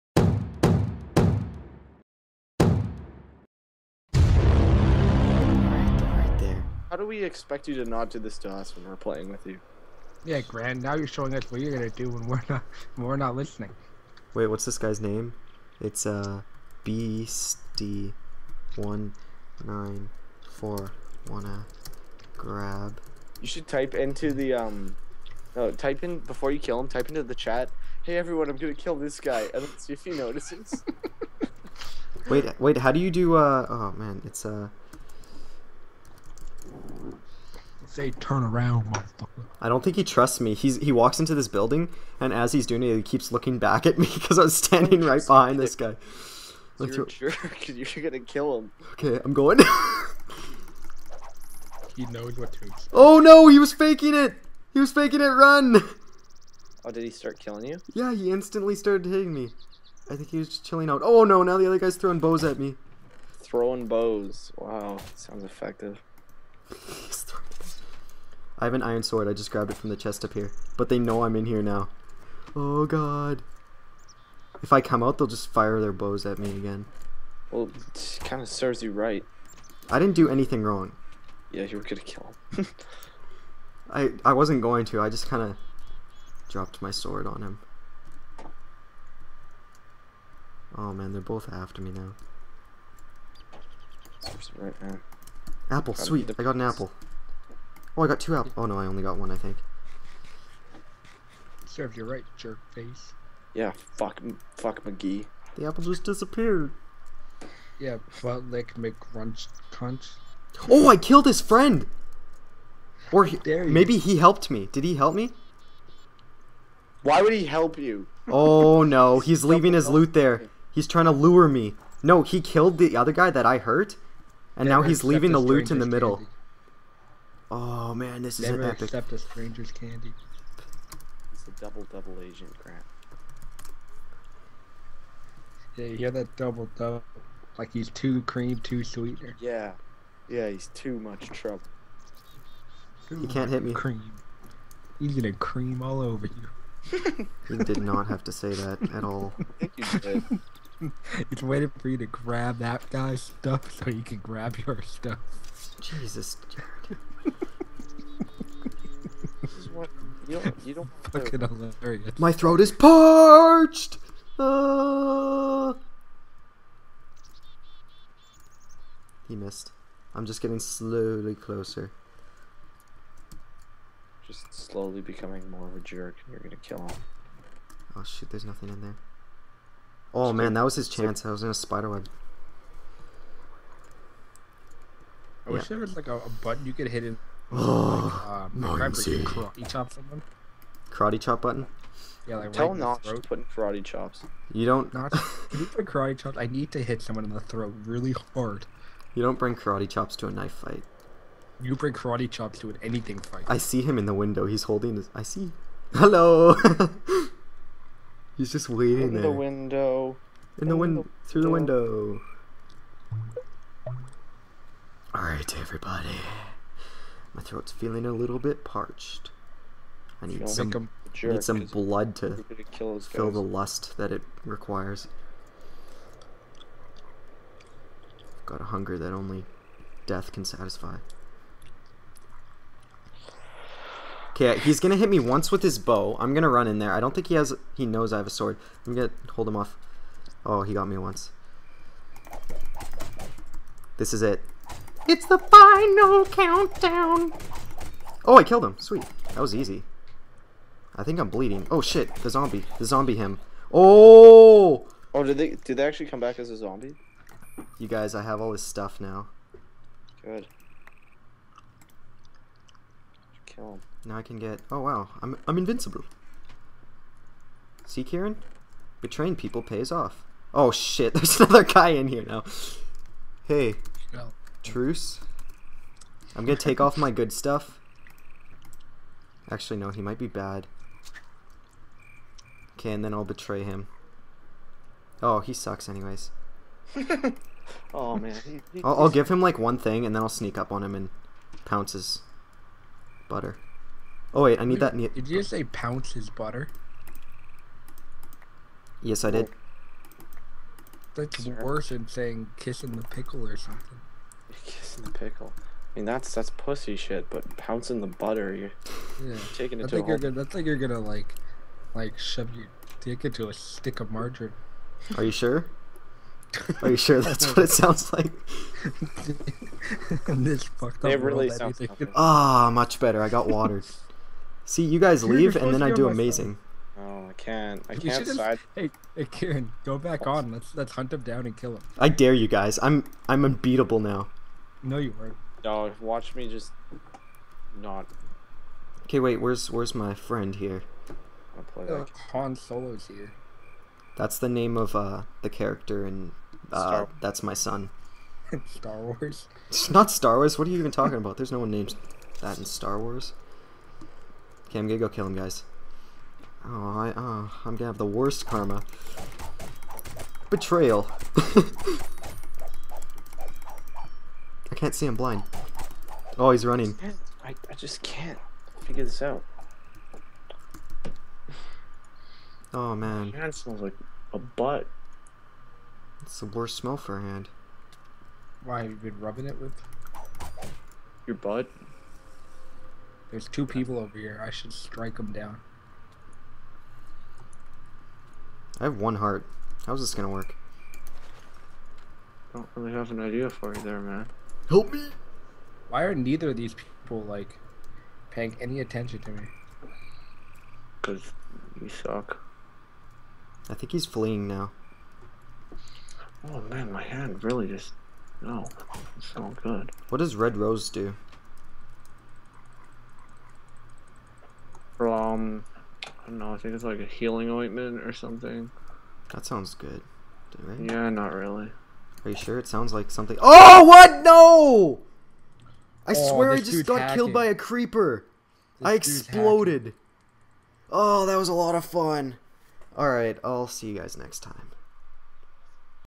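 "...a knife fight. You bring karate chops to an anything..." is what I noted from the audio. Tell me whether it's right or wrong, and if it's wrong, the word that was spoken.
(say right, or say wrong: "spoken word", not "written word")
right.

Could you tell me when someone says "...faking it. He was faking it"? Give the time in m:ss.
0:53.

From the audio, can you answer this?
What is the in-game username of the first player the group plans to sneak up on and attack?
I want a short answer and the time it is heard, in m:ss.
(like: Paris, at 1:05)
Beastie 194, at 0:16.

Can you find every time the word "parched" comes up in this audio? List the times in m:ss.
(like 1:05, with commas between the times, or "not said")
2:42, 3:38.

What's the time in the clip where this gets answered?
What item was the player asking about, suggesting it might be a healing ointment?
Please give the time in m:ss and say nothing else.
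6:50.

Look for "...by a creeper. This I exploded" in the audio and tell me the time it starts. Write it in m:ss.
7:07.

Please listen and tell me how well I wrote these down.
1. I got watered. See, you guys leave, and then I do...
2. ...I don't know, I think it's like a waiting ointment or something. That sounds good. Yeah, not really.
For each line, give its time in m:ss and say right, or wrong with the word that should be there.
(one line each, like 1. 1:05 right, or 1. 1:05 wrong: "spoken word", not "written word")
1. 5:23 right
2. 6:56 wrong: "healing", not "waiting".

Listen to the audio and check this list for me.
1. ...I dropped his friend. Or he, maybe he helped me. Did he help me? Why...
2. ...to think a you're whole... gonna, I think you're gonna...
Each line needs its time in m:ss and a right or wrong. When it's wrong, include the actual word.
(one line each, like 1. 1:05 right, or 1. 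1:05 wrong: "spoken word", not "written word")
1. 1:50 wrong: "killed", not "dropped"
2. 5:09 right.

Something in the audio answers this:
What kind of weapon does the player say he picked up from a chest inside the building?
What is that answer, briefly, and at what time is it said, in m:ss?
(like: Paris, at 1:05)
Iron sword, at 1:08.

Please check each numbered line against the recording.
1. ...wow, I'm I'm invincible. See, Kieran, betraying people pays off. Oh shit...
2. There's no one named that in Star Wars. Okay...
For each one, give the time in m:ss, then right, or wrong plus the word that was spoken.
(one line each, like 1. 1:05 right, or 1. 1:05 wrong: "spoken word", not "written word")
1. 4:24 right
2. 5:51 right.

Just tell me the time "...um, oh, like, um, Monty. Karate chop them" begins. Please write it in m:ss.
3:07.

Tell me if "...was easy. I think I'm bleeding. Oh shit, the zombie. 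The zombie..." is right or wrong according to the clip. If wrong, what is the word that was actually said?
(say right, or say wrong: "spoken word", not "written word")
right.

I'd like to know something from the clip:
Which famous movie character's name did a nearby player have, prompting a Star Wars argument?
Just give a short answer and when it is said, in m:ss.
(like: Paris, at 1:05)
Han Solo, at 5:42.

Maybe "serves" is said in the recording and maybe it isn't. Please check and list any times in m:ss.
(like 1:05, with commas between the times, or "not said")
1:18, 1:41.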